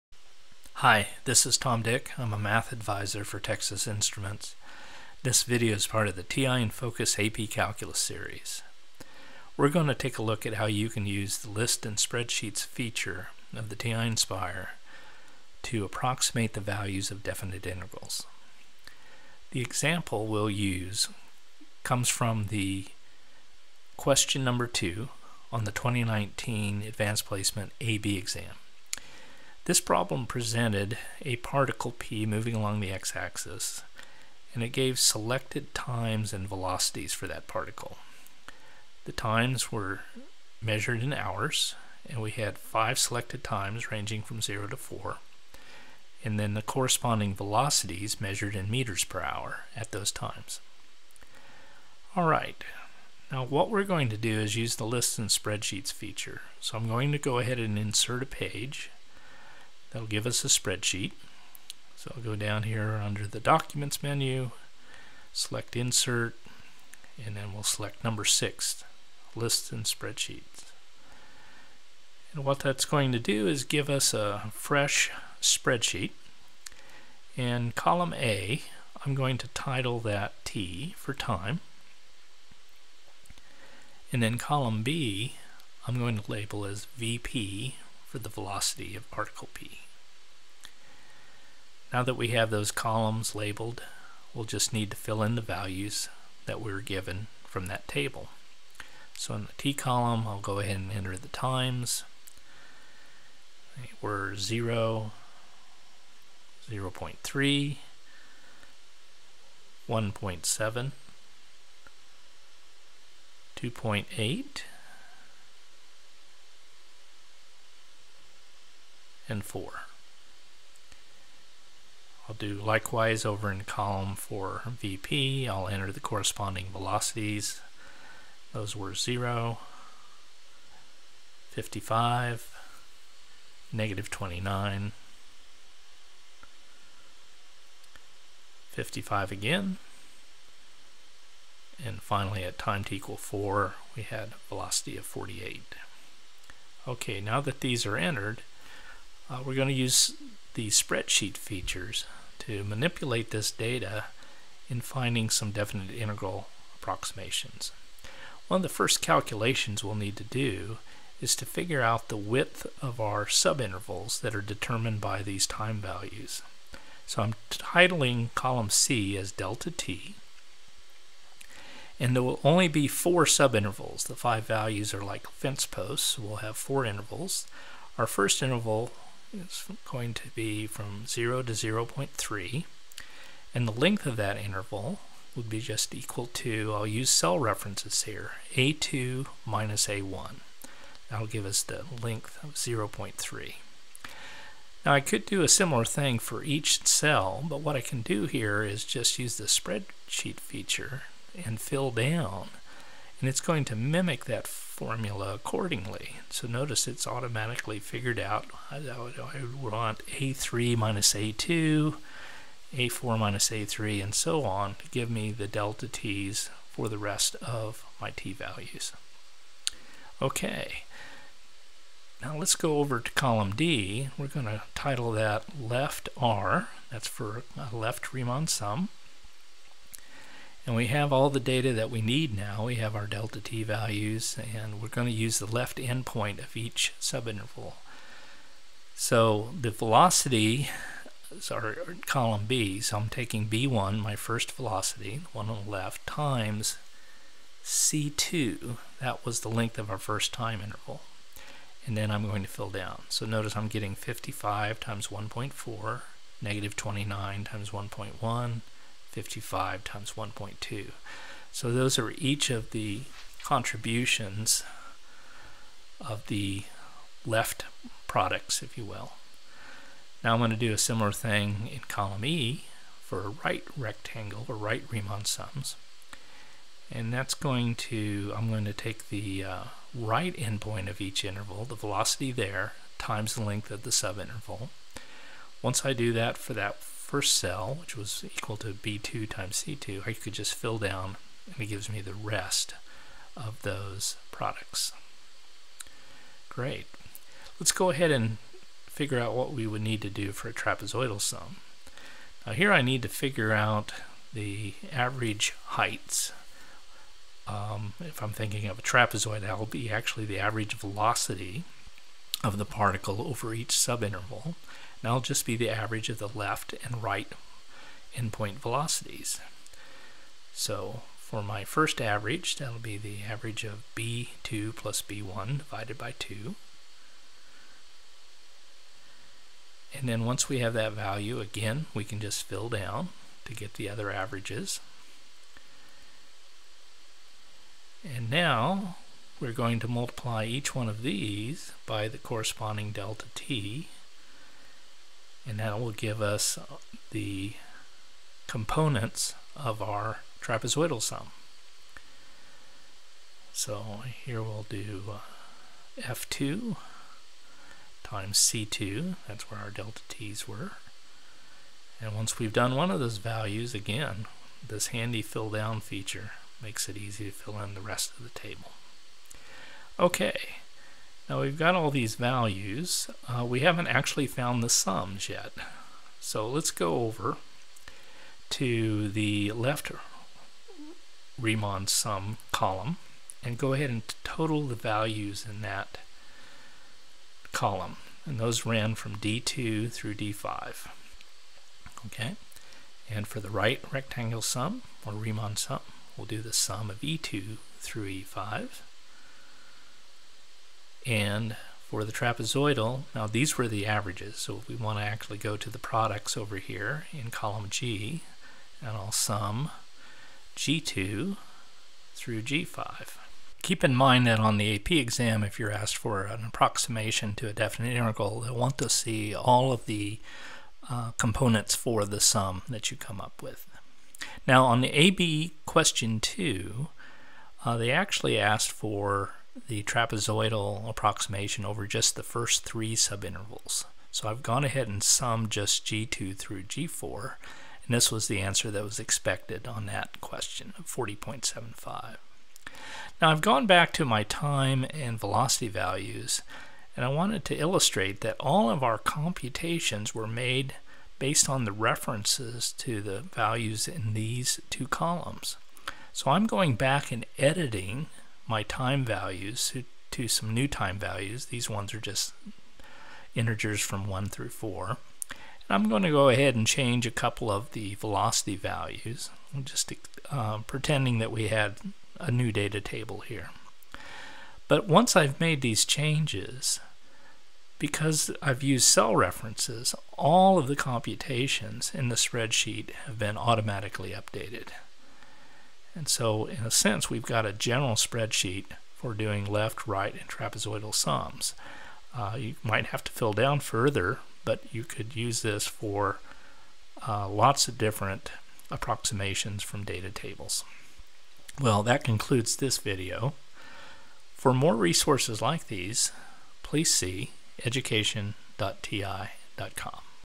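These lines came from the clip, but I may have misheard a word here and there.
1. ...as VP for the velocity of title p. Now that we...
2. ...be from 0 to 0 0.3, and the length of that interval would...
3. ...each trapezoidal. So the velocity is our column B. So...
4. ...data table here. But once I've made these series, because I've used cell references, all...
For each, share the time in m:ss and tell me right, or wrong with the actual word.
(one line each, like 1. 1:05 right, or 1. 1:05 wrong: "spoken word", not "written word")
1. 1:26 wrong: "particle", not "title"
2. 3:00 right
3. 3:56 wrong: "subinterval", not "trapezoidal"
4. 7:52 wrong: "changes", not "series".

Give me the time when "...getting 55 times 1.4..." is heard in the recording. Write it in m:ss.
4:13.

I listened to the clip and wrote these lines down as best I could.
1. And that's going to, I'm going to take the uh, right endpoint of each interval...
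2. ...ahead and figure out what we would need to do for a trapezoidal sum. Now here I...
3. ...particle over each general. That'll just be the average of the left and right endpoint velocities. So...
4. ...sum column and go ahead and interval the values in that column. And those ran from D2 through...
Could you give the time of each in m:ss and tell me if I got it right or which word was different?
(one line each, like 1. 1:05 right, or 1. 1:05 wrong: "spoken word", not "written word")
1. 4:36 right
2. 4:57 right
3. 5:12 wrong: "subinterval", not "general"
4. 6:21 wrong: "total", not "interval".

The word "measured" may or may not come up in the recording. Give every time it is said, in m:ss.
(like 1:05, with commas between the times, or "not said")
0:40, 0:48.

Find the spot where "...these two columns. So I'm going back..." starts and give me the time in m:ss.
7:34.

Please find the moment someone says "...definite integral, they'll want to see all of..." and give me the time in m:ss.
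6:57.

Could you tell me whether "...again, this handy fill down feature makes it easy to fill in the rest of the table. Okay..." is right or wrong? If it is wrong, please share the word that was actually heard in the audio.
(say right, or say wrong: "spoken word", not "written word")
right.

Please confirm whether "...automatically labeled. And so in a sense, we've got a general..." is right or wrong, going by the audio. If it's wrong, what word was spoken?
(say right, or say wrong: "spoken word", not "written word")
wrong: "updated", not "labeled".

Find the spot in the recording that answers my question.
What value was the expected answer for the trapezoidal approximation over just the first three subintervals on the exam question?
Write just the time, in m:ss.
7:20.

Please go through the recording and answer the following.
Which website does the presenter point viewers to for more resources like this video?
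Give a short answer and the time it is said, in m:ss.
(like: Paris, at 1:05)
education.ti.com, at 8:27.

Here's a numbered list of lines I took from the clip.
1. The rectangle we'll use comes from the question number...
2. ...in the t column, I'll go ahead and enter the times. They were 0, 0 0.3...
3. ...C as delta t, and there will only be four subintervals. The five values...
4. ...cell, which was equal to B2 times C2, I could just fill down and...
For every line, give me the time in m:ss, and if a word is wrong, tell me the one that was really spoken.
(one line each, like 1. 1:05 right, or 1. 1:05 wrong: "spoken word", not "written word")
1. 0:19 wrong: "example", not "rectangle"
2. 1:39 right
3. 2:48 right
4. 4:47 right.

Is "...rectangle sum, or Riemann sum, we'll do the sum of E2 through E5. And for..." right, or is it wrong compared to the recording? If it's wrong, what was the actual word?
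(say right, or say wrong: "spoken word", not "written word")
right.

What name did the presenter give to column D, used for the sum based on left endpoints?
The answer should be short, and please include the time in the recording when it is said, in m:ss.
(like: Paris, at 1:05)
left R, at 3:45.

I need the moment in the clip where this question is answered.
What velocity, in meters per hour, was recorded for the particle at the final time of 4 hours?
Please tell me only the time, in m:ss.
2:25.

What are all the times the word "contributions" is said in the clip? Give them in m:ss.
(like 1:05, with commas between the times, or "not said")
4:23.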